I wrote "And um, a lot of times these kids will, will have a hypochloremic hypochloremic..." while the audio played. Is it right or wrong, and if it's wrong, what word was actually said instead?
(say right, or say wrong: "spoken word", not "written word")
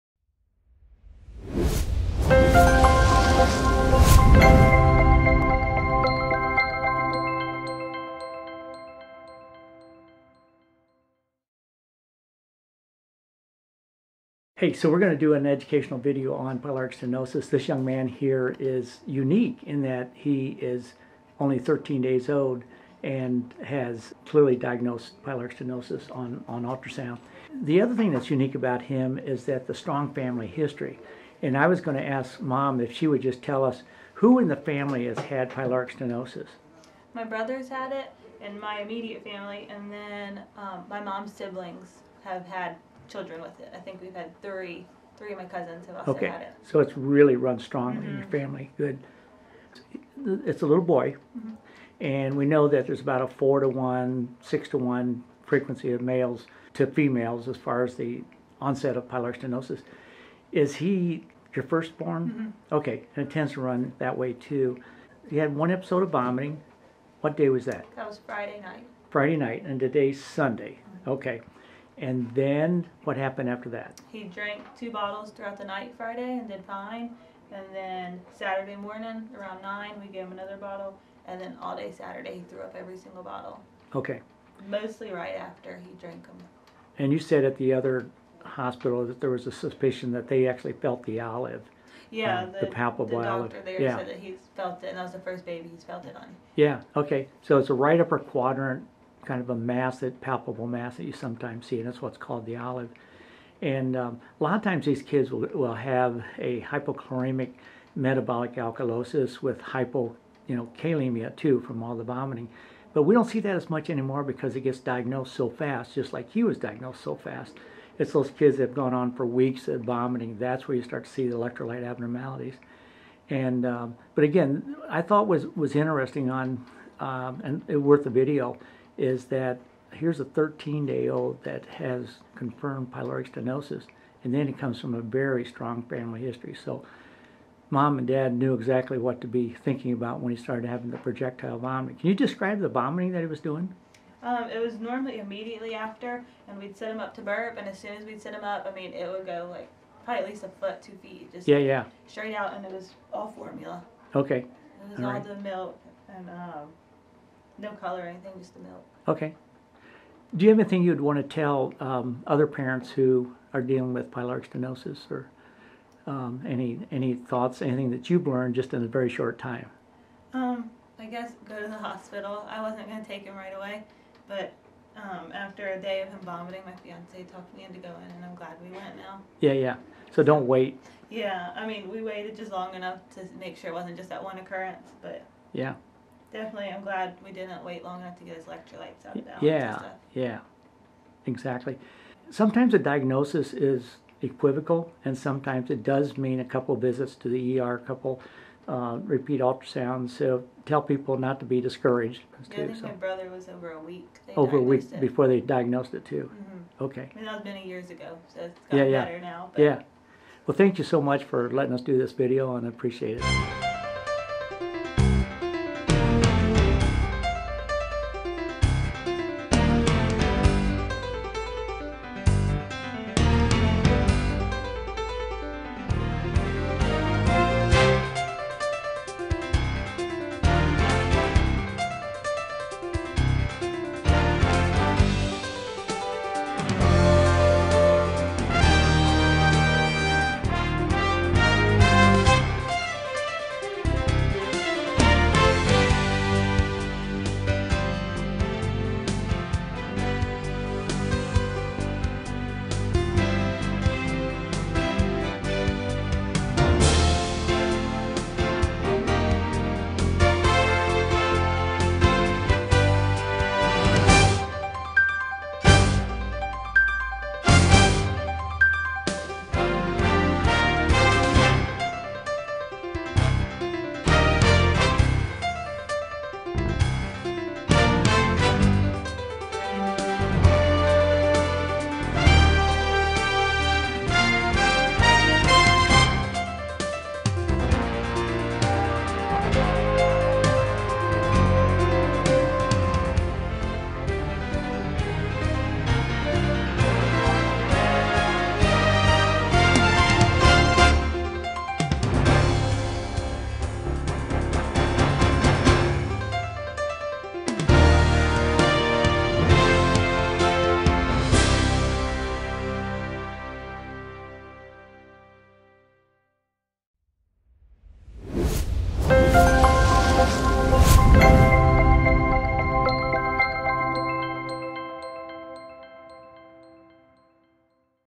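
wrong: "metabolic", not "hypochloremic".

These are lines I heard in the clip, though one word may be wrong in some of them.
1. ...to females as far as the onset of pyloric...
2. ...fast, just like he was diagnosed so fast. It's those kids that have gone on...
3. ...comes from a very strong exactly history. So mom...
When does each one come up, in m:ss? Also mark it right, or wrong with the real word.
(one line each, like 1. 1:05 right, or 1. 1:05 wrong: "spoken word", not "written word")
1. 0:56 right
2. 1:55 right
3. 2:14 wrong: "family", not "exactly".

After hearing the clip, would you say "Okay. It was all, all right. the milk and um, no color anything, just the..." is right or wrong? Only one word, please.
right.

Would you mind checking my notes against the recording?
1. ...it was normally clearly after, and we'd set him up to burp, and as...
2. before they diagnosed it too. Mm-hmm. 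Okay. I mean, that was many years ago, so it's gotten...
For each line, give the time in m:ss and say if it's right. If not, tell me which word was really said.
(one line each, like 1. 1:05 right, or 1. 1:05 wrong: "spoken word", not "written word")
1. 2:24 wrong: "immediately", not "clearly"
2. 3:25 right.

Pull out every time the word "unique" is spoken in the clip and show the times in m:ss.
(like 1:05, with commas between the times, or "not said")
0:19, 0:28.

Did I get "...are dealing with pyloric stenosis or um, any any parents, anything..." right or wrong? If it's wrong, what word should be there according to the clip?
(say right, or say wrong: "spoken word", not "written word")
wrong: "thoughts", not "parents".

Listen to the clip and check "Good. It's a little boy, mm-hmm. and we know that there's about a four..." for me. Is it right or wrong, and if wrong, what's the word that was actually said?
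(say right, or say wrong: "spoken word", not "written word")
right.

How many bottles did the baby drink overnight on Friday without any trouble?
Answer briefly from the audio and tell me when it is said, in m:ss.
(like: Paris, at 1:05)
2, at 1:14.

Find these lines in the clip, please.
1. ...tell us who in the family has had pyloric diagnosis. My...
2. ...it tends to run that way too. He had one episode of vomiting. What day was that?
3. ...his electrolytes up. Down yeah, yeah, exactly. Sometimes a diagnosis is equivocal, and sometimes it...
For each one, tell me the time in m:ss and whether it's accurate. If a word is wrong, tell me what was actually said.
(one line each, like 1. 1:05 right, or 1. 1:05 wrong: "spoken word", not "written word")
1. 0:33 wrong: "stenosis", not "diagnosis"
2. 1:03 right
3. 3:08 right.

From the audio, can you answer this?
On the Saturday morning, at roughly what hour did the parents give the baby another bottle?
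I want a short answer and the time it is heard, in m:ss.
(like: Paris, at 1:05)
9, at 1:19.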